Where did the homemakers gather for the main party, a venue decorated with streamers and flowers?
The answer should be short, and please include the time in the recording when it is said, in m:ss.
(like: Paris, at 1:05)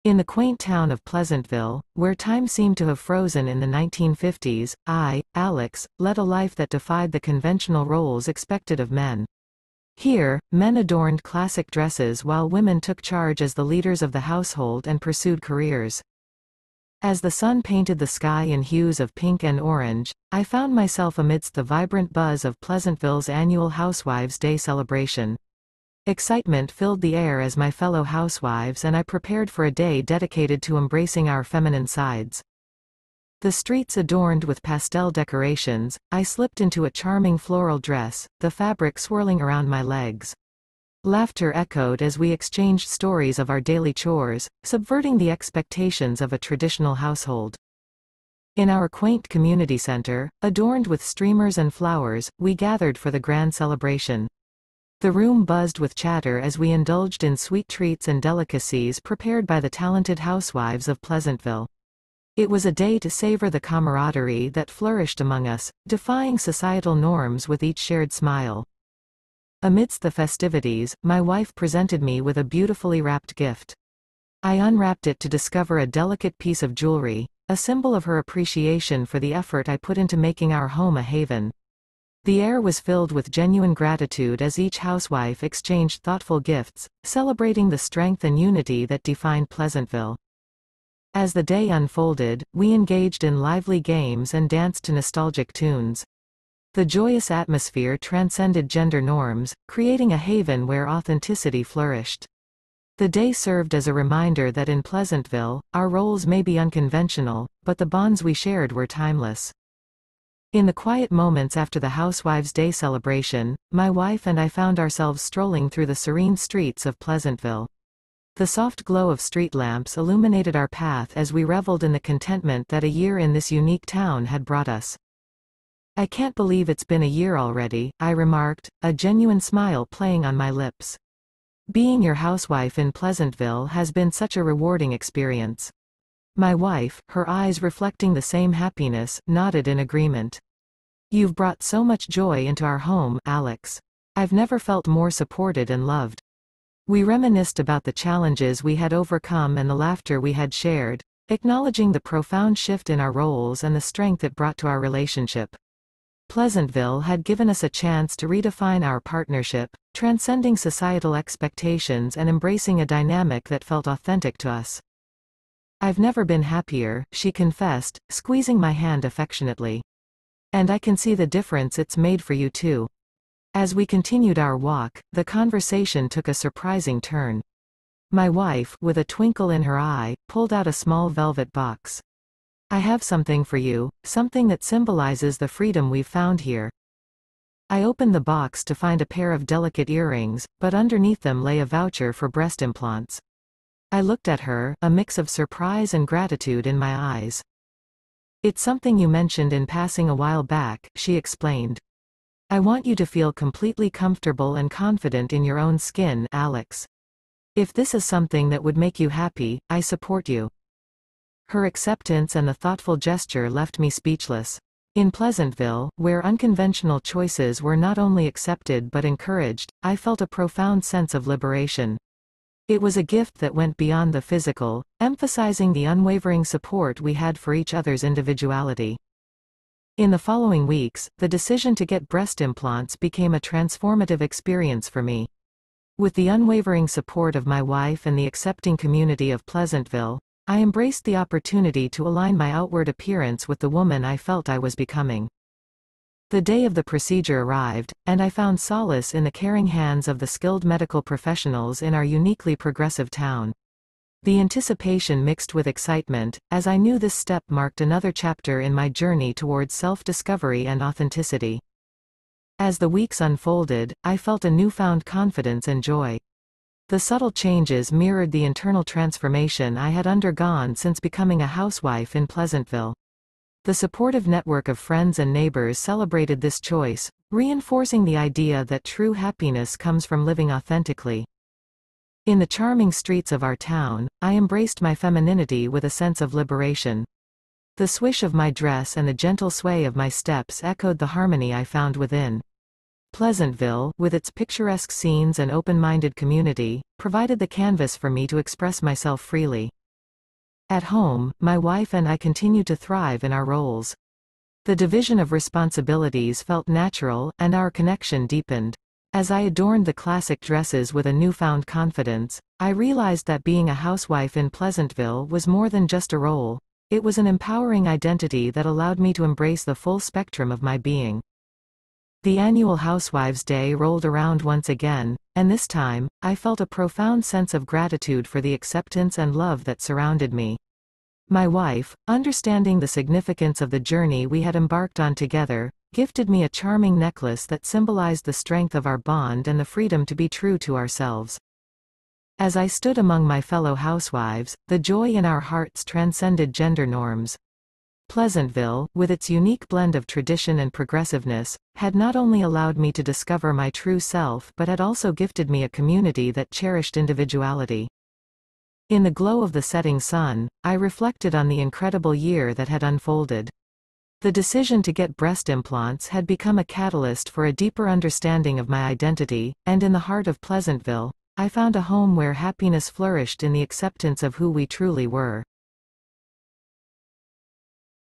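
Community center, at 0:49.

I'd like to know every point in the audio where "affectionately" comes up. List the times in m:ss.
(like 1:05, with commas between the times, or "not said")
2:49.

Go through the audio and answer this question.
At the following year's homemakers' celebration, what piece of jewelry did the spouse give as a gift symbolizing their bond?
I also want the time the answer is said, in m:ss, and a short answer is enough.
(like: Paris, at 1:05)
Necklace, at 5:36.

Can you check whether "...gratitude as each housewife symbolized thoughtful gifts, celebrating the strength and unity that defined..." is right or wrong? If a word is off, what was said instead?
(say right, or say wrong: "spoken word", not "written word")
wrong: "exchanged", not "symbolized".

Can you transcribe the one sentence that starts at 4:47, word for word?
The swish of my dress and the gentle sway of my steps echoed the harmony I found within.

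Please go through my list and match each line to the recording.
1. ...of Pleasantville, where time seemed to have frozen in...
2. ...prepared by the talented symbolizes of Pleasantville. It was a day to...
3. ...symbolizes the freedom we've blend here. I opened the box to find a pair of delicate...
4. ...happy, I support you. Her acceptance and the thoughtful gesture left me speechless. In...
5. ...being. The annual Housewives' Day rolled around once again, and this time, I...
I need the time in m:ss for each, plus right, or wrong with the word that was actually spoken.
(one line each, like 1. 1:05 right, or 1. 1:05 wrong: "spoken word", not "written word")
1. 0:00 right
2. 0:58 wrong: "housewives", not "symbolizes"
3. 3:04 wrong: "found", not "blend"
4. 3:29 right
5. 5:20 right.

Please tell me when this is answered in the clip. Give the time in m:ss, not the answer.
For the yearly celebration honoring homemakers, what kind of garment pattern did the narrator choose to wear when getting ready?
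0:37.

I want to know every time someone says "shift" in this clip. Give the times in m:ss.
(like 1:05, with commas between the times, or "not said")
2:32.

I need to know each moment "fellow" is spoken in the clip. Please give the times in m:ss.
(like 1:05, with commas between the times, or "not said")
0:27, 5:43.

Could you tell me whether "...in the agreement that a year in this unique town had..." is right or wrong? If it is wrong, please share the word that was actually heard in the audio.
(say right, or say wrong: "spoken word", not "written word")
wrong: "contentment", not "agreement".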